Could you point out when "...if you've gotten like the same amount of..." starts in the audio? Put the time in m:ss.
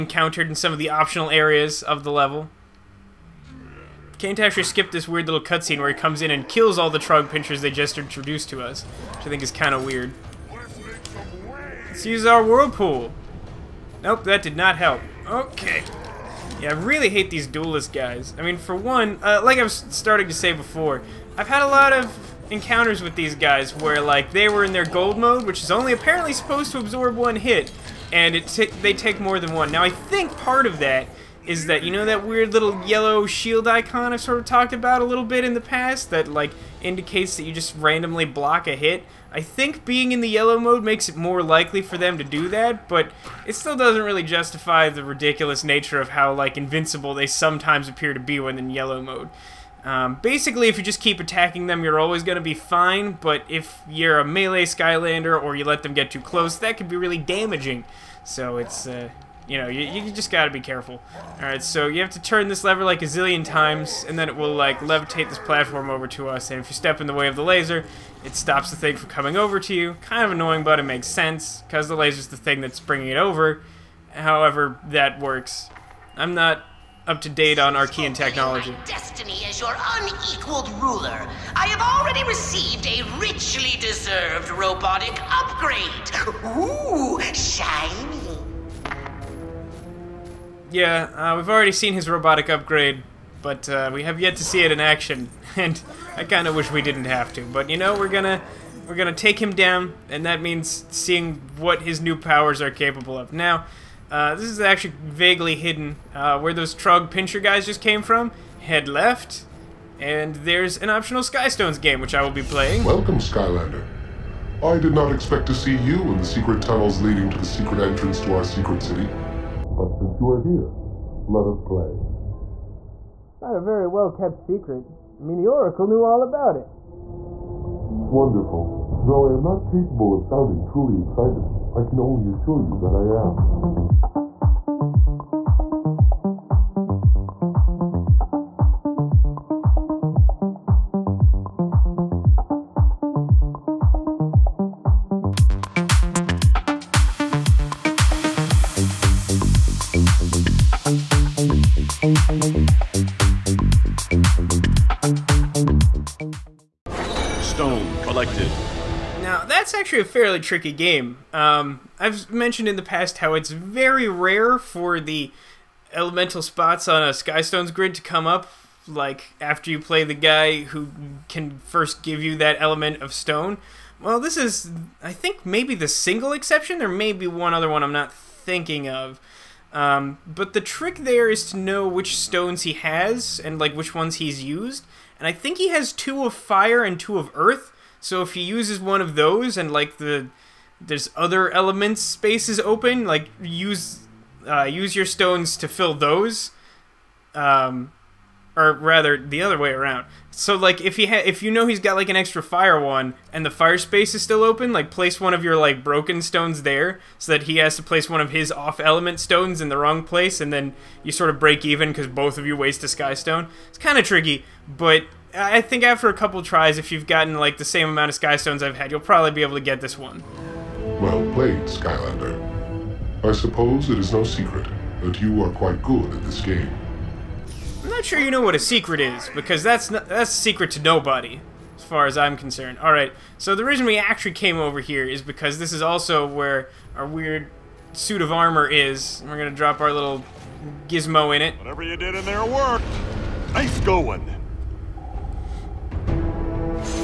3:36.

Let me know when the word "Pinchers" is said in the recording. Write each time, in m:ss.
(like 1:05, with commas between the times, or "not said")
0:07, 1:47.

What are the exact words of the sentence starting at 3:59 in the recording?
We're gonna drop our little gizmo in it.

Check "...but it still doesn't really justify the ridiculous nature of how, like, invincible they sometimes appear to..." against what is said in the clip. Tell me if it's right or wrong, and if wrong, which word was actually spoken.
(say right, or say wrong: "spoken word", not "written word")
right.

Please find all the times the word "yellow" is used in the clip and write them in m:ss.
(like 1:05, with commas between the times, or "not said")
0:32, 0:40, 0:48.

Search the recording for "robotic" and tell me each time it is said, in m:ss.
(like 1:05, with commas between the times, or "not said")
1:24, 1:32.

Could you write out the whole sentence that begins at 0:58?
So it's, uh, you know, you, you just gotta be careful.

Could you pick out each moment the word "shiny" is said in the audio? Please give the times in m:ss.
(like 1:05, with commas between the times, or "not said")
1:27.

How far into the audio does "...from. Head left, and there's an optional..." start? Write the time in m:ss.
1:48.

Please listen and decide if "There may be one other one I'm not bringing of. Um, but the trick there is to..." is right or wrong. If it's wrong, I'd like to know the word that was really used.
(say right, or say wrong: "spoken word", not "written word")
wrong: "thinking", not "bringing".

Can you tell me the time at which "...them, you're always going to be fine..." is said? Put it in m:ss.
0:51.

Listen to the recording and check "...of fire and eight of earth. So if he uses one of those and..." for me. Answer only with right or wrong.
wrong.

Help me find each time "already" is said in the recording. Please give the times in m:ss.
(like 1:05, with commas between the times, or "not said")
1:21, 1:31.